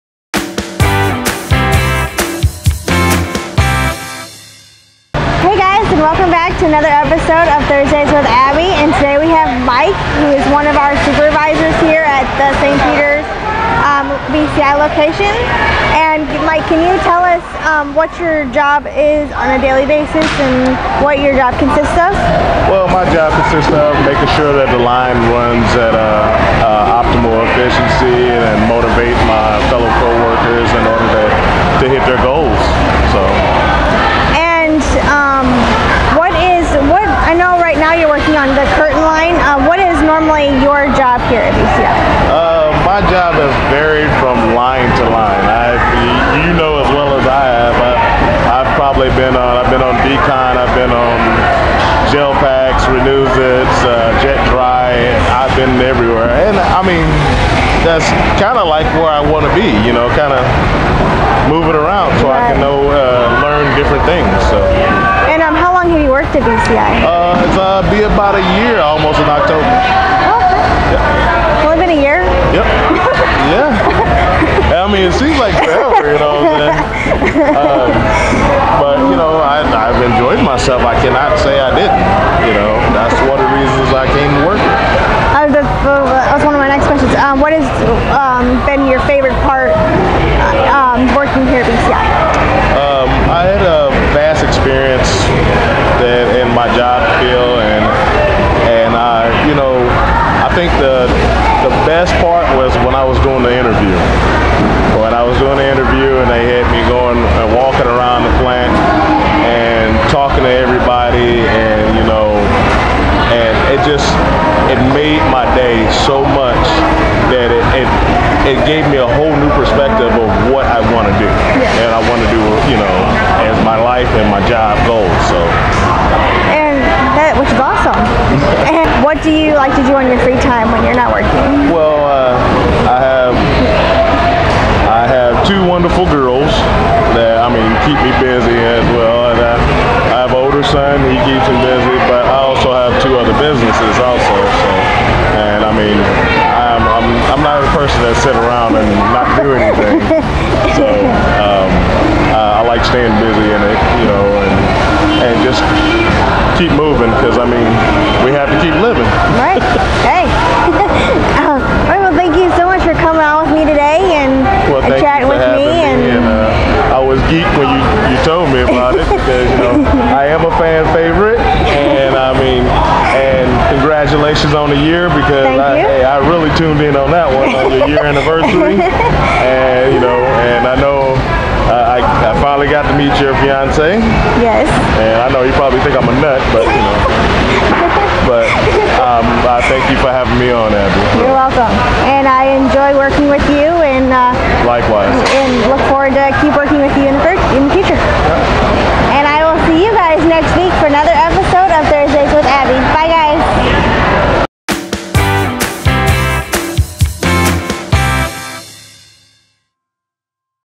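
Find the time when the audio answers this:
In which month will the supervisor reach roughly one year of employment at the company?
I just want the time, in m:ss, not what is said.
1:09.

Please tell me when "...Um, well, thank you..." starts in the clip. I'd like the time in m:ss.
2:41.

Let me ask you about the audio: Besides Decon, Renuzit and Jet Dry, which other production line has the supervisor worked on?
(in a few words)
Gel Packs.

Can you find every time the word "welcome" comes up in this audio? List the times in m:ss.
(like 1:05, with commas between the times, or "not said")
0:06, 3:11.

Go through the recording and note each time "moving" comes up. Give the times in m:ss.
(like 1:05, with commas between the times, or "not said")
1:01, 2:36.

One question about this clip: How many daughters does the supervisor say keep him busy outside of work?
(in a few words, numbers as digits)
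2.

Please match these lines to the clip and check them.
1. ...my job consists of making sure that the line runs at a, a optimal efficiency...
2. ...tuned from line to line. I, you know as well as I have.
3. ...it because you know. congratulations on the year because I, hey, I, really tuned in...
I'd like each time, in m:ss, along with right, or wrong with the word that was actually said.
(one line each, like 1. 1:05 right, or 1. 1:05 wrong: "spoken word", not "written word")
1. 0:22 right
2. 0:43 wrong: "varied", not "tuned"
3. 2:48 right.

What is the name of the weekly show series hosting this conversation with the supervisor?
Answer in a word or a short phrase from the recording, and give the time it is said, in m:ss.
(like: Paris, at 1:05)
Thursdays with Abby, at 0:07.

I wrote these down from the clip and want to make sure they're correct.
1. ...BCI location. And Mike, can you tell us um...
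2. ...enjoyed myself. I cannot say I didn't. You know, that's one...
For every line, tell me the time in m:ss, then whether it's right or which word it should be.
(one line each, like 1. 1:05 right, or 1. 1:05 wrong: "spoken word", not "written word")
1. 0:14 right
2. 1:20 right.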